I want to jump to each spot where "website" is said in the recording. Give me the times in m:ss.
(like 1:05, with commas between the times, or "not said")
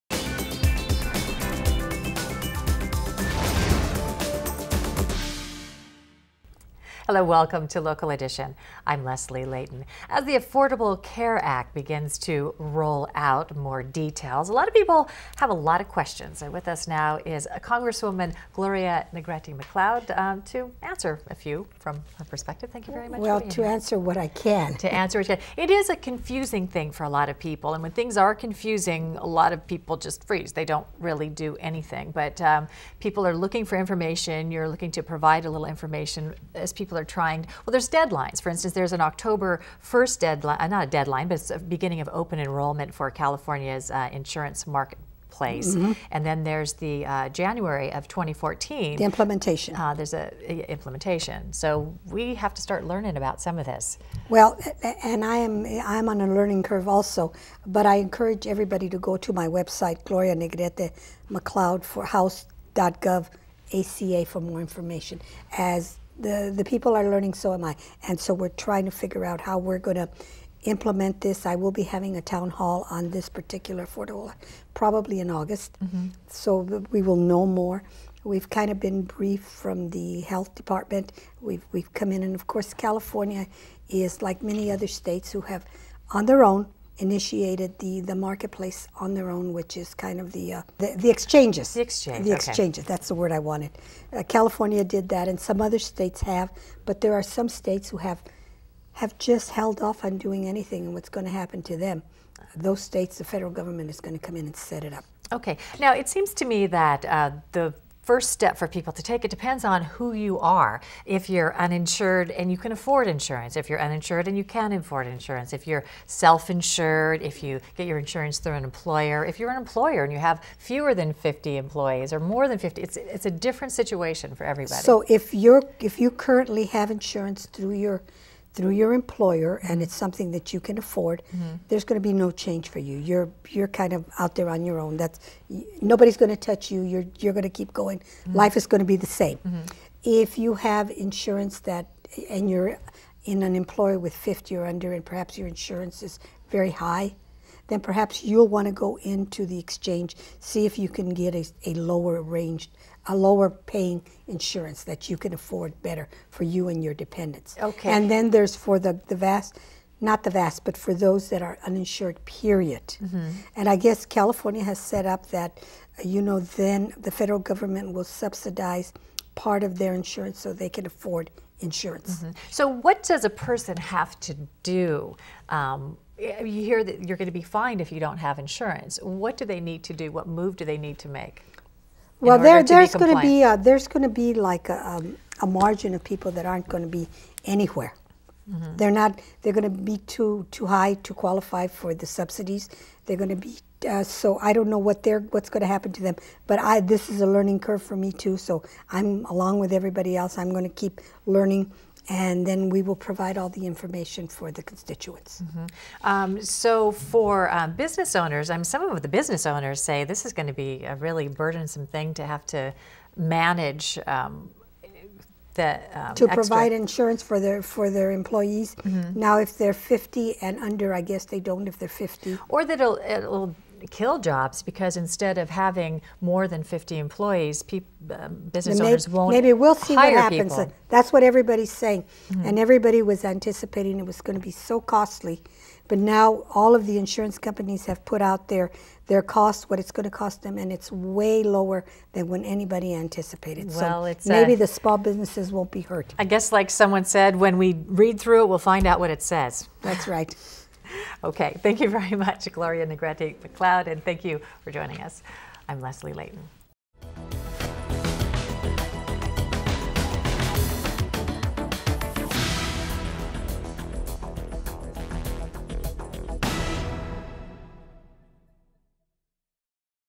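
0:59.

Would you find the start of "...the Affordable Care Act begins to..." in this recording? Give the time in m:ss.
0:10.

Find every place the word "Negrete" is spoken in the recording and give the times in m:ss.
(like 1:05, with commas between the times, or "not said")
0:19, 1:00, 4:12.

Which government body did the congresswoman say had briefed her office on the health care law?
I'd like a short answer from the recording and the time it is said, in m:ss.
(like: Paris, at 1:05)
health department, at 1:20.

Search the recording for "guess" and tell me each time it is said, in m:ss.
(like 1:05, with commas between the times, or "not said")
2:43, 3:41, 4:06.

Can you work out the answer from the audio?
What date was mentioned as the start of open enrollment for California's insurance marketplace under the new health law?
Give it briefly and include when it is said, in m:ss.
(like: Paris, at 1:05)
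October 1st, at 0:39.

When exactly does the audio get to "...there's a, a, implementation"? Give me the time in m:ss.
0:49.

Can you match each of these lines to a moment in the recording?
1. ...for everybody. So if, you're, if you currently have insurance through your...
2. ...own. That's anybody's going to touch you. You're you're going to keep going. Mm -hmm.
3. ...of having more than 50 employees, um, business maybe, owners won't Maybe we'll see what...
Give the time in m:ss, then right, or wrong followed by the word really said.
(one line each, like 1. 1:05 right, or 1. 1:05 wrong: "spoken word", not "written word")
1. 2:04 right
2. 2:14 wrong: "nobody", not "anybody"
3. 3:45 right.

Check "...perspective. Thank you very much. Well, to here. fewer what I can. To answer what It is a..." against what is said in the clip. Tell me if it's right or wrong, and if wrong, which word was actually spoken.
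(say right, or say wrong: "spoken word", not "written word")
wrong: "answer", not "fewer".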